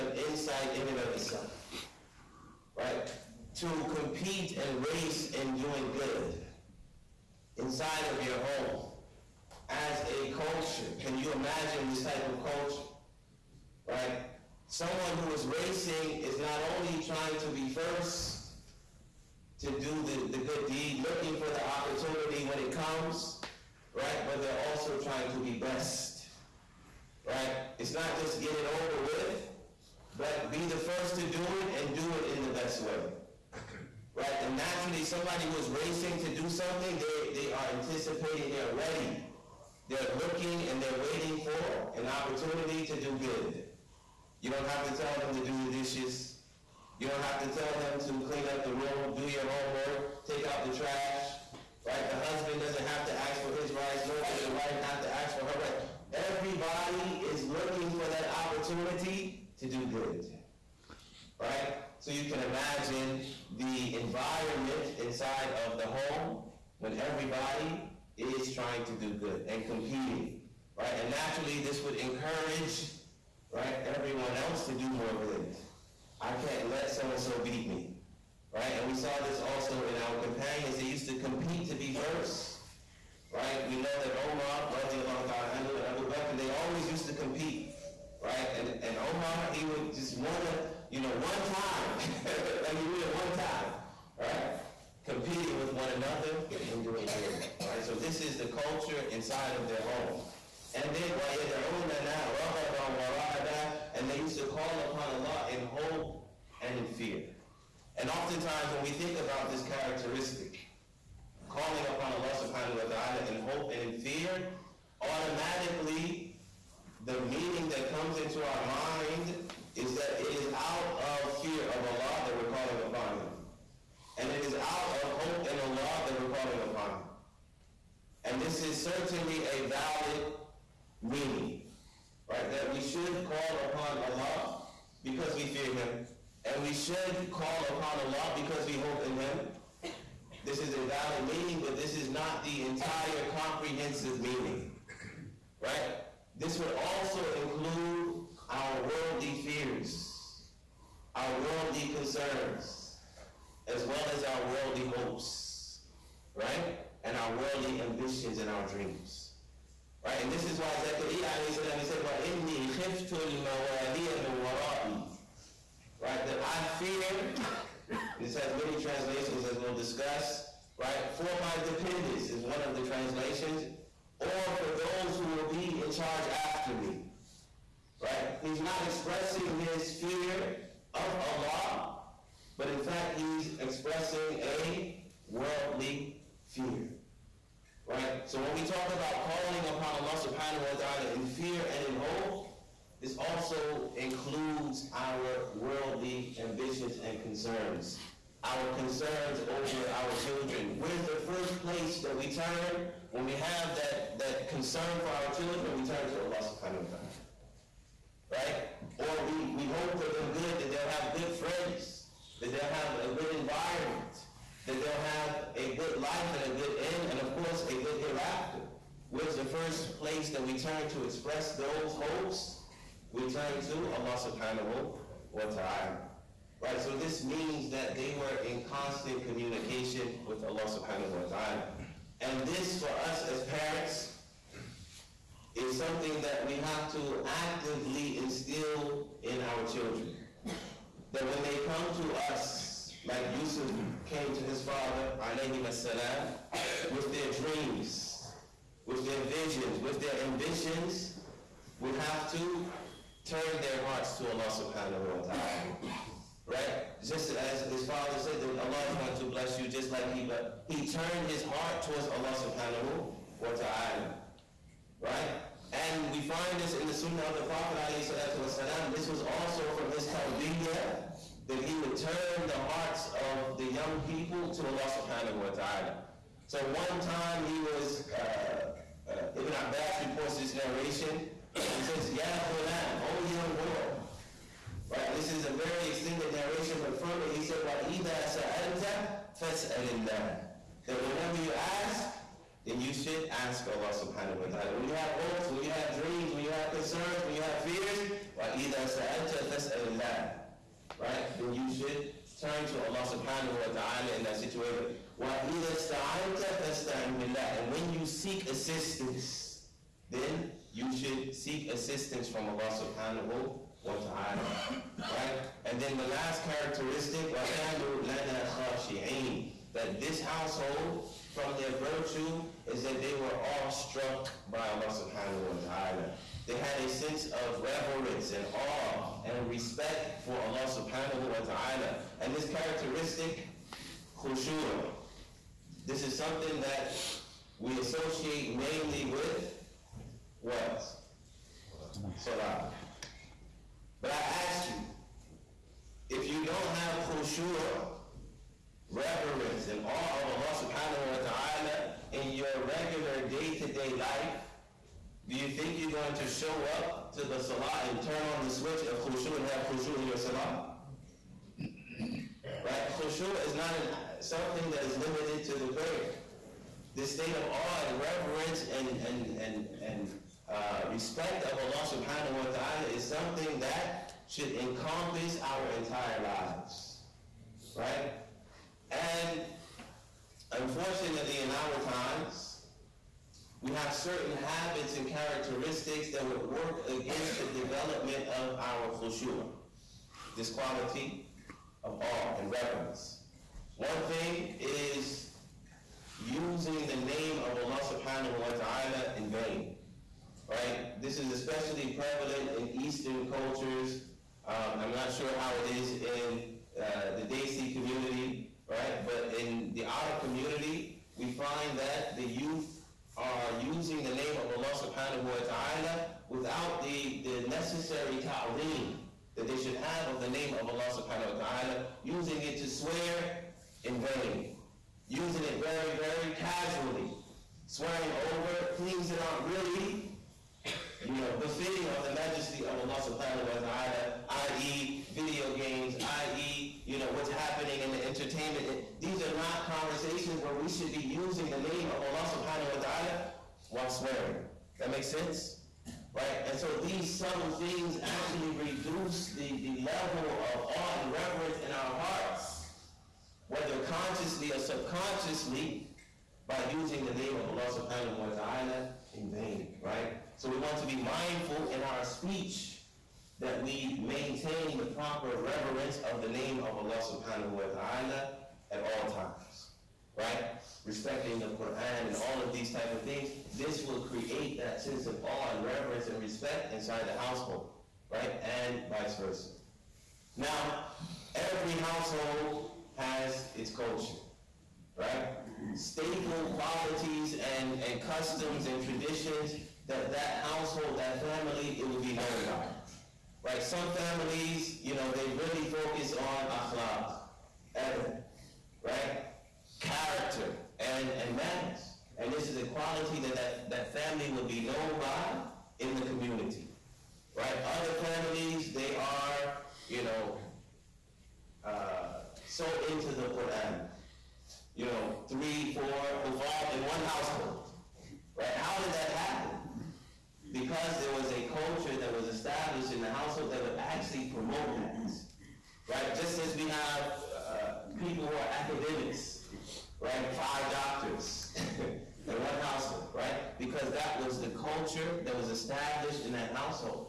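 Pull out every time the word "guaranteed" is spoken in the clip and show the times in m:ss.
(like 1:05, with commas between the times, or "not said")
not said.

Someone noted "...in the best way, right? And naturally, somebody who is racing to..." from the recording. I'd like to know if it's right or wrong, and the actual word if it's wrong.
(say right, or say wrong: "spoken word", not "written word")
right.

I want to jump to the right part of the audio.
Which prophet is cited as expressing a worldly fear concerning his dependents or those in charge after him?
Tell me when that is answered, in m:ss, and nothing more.
2:40.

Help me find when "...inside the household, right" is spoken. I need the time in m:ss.
7:56.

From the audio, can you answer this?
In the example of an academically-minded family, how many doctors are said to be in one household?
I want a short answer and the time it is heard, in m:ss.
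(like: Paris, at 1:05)
5, at 8:50.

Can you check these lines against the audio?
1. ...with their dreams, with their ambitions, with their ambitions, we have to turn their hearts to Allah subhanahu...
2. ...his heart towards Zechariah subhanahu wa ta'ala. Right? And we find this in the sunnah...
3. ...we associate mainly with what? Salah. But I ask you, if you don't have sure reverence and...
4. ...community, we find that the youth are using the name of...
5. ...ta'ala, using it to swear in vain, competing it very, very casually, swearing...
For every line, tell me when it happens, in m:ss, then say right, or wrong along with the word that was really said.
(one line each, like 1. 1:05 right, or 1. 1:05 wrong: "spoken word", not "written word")
1. 4:06 wrong: "visions", not "ambitions"
2. 4:21 wrong: "Allah", not "Zechariah"
3. 5:37 right
4. 6:50 right
5. 7:01 wrong: "using", not "competing".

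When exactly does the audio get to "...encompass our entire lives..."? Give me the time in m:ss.
6:14.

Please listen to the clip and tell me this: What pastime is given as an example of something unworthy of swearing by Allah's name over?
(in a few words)
video games.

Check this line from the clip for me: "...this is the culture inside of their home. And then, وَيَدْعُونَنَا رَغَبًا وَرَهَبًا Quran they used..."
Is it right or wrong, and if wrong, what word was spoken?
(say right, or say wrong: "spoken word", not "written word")
wrong: "And", not "Quran".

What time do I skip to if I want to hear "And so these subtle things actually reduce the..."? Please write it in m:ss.
7:26.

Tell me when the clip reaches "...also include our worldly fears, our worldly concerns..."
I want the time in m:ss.
2:26.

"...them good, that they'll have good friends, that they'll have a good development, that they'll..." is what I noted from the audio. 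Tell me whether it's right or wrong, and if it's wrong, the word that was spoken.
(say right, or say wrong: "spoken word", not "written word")
wrong: "environment", not "development".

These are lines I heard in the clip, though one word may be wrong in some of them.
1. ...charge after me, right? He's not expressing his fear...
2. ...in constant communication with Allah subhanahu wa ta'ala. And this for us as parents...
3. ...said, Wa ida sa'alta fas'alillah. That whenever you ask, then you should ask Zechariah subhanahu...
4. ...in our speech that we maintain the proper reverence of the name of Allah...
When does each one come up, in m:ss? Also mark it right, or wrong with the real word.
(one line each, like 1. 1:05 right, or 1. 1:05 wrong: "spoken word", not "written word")
1. 2:55 right
2. 3:48 right
3. 4:47 wrong: "Allah", not "Zechariah"
4. 7:41 right.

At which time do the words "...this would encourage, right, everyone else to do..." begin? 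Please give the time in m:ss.
1:11.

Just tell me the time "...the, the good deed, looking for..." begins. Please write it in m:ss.
0:20.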